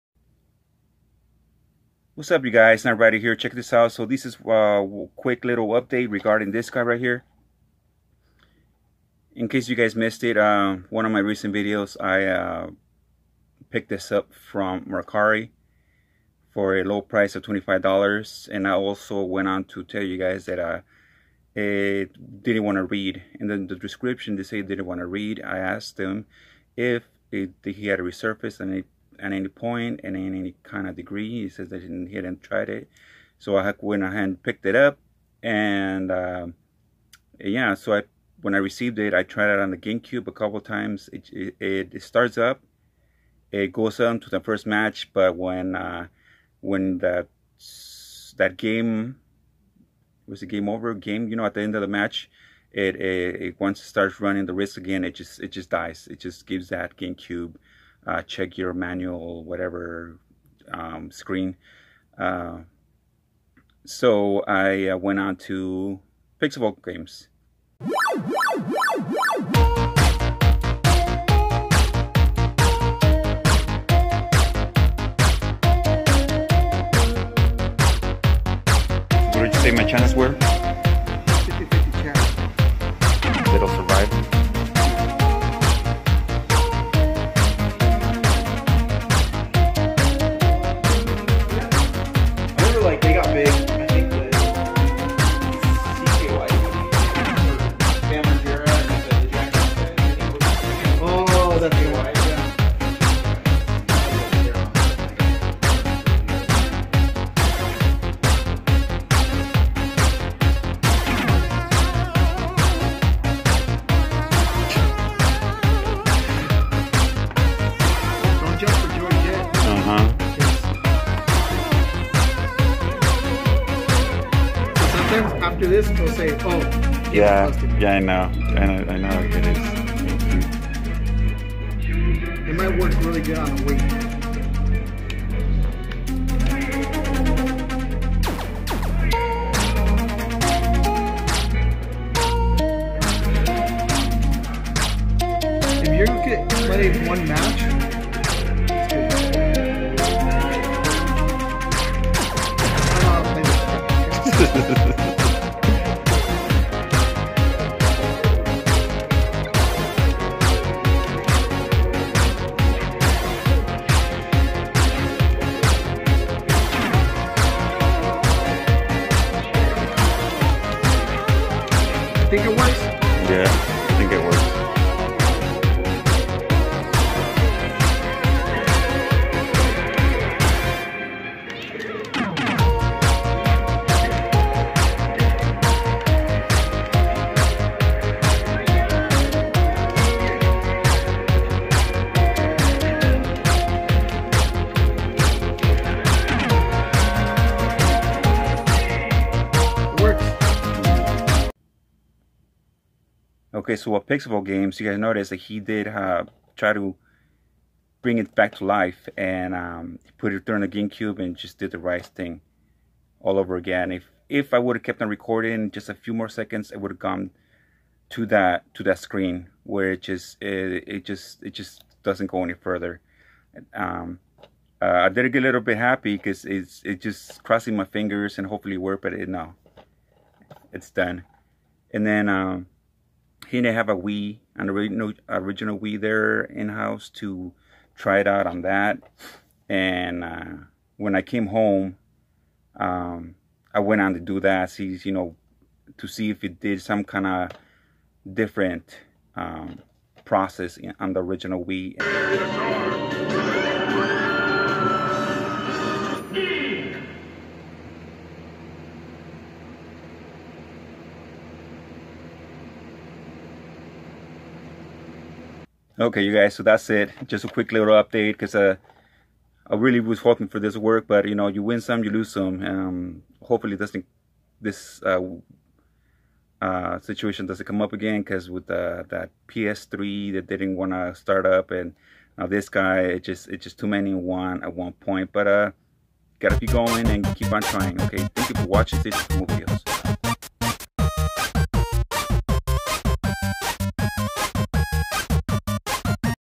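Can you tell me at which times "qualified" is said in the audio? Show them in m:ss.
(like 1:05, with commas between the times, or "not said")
not said.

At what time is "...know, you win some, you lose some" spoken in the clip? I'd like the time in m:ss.
4:31.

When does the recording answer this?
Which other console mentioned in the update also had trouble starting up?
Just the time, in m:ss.
4:39.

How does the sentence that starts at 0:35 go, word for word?
And uh, yeah, so I when I received it, I tried it on the GameCube a couple times.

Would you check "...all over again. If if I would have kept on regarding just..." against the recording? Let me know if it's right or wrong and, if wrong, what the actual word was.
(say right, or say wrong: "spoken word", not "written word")
wrong: "recording", not "regarding".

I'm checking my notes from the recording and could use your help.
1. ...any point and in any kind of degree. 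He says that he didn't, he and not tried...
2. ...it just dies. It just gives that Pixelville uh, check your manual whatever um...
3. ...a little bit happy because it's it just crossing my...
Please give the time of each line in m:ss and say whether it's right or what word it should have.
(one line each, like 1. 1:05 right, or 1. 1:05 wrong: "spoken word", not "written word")
1. 0:29 right
2. 0:55 wrong: "GameCube", not "Pixelville"
3. 3:45 right.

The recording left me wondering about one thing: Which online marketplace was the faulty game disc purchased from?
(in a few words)
Mercari.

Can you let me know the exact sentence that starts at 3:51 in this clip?
And then um, he didn't have a Wii, an original original Wii there in house to try it out on that.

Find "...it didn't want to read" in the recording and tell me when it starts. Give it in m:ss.
0:21.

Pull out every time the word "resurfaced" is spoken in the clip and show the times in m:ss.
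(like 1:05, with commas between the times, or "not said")
0:28.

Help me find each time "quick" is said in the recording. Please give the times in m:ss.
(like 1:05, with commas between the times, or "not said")
0:05, 4:27.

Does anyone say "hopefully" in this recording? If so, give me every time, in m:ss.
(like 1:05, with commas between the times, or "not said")
3:48, 4:33.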